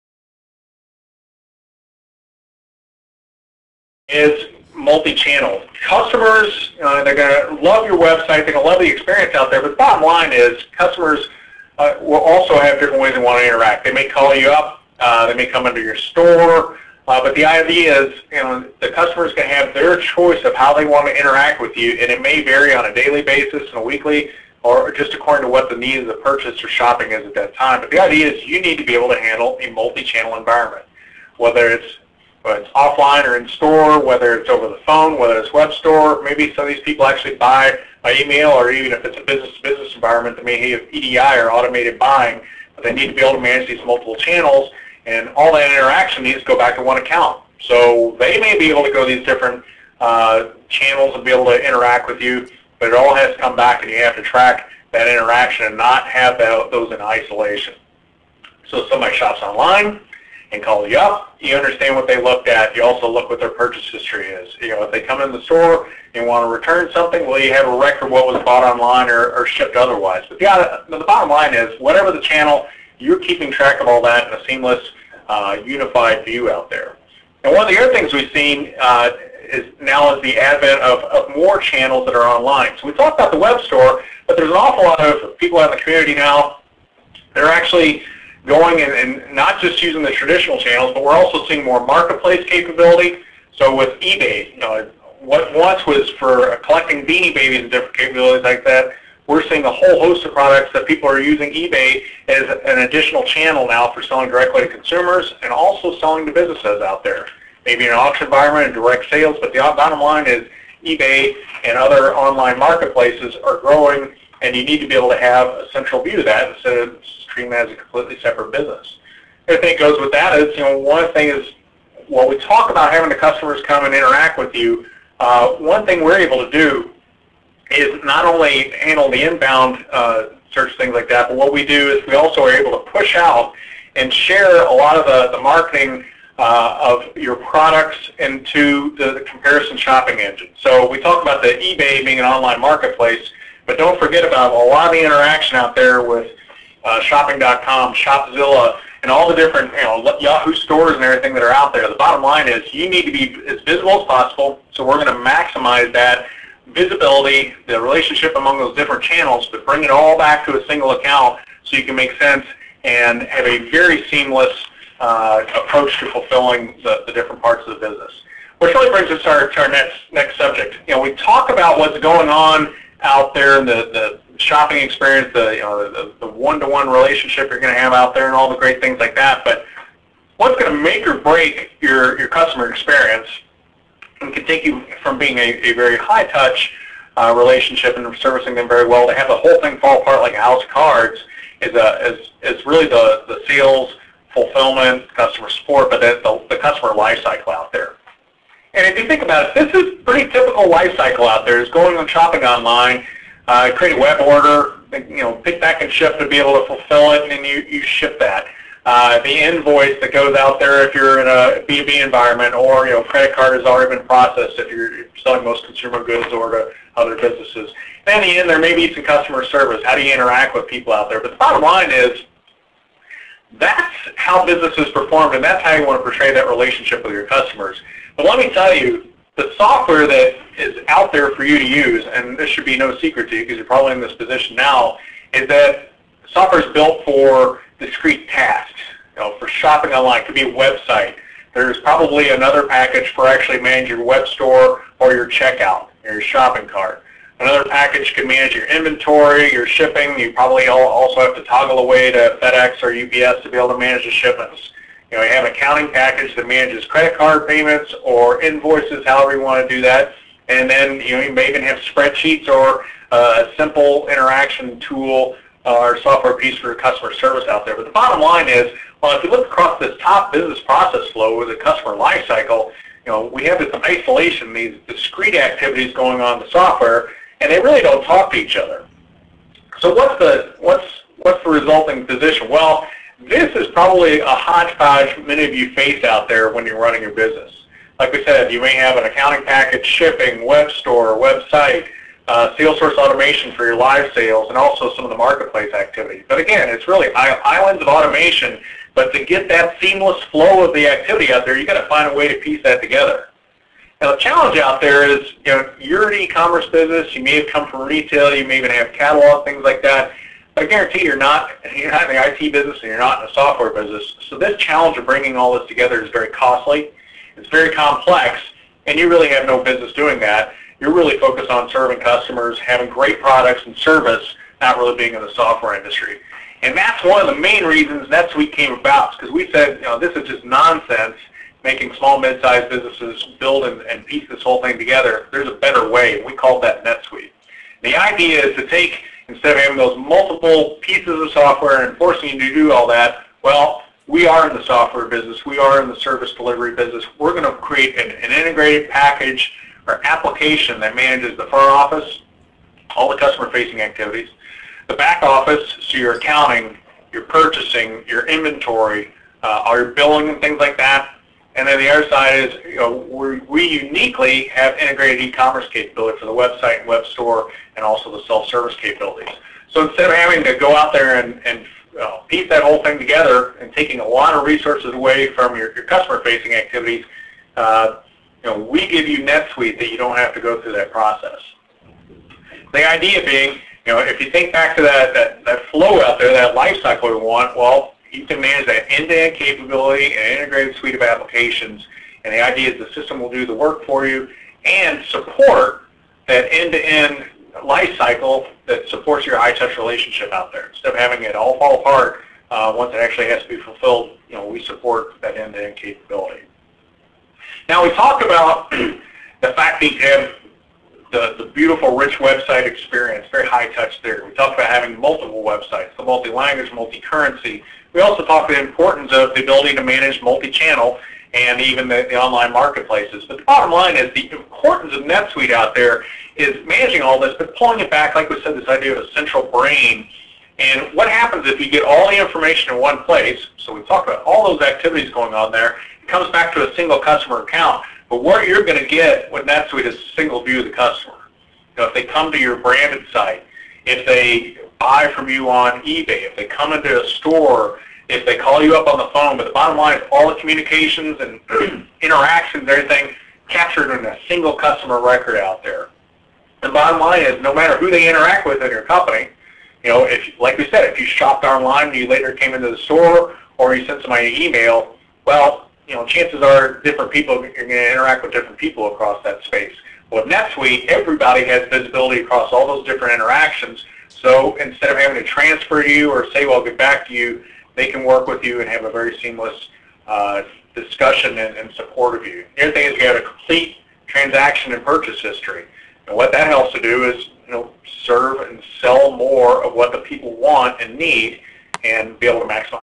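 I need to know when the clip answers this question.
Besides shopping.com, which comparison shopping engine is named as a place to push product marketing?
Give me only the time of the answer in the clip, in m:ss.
2:27.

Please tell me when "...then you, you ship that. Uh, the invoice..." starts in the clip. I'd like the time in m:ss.
3:27.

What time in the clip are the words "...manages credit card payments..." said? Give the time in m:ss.
4:16.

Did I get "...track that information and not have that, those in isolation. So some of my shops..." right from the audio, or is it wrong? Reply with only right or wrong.
wrong.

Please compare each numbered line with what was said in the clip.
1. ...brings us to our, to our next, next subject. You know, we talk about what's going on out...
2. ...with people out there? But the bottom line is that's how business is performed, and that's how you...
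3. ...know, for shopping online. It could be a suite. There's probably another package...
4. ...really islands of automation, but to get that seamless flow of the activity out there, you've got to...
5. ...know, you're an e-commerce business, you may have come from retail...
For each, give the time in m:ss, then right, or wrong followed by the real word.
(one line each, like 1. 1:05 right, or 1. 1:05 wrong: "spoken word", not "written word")
1. 2:48 right
2. 3:40 right
3. 3:59 wrong: "website", not "suite"
4. 4:56 right
5. 5:05 right.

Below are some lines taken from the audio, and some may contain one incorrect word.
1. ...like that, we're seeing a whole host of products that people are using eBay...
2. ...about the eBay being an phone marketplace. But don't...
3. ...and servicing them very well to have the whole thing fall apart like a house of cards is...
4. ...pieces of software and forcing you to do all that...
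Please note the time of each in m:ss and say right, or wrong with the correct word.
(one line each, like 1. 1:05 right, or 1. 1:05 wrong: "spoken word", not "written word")
1. 1:38 right
2. 2:21 wrong: "online", not "phone"
3. 3:07 right
4. 5:40 right.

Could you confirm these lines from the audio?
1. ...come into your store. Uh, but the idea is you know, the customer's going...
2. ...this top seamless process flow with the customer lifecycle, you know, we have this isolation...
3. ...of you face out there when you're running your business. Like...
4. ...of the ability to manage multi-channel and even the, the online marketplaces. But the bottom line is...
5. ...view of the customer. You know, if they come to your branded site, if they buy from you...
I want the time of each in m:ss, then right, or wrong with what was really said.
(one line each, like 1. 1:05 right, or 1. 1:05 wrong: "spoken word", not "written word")
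1. 0:15 right
2. 4:29 wrong: "business", not "seamless"
3. 4:45 right
4. 6:59 right
5. 7:20 right.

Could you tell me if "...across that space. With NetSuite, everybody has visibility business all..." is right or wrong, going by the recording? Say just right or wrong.
wrong.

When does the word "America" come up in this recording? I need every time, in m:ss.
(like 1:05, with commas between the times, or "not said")
not said.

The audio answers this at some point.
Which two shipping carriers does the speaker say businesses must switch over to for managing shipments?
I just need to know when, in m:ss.
4:12.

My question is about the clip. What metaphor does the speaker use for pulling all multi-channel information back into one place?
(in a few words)
a central brain.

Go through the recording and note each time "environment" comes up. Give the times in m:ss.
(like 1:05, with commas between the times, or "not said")
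0:30, 0:39, 1:48, 3:32.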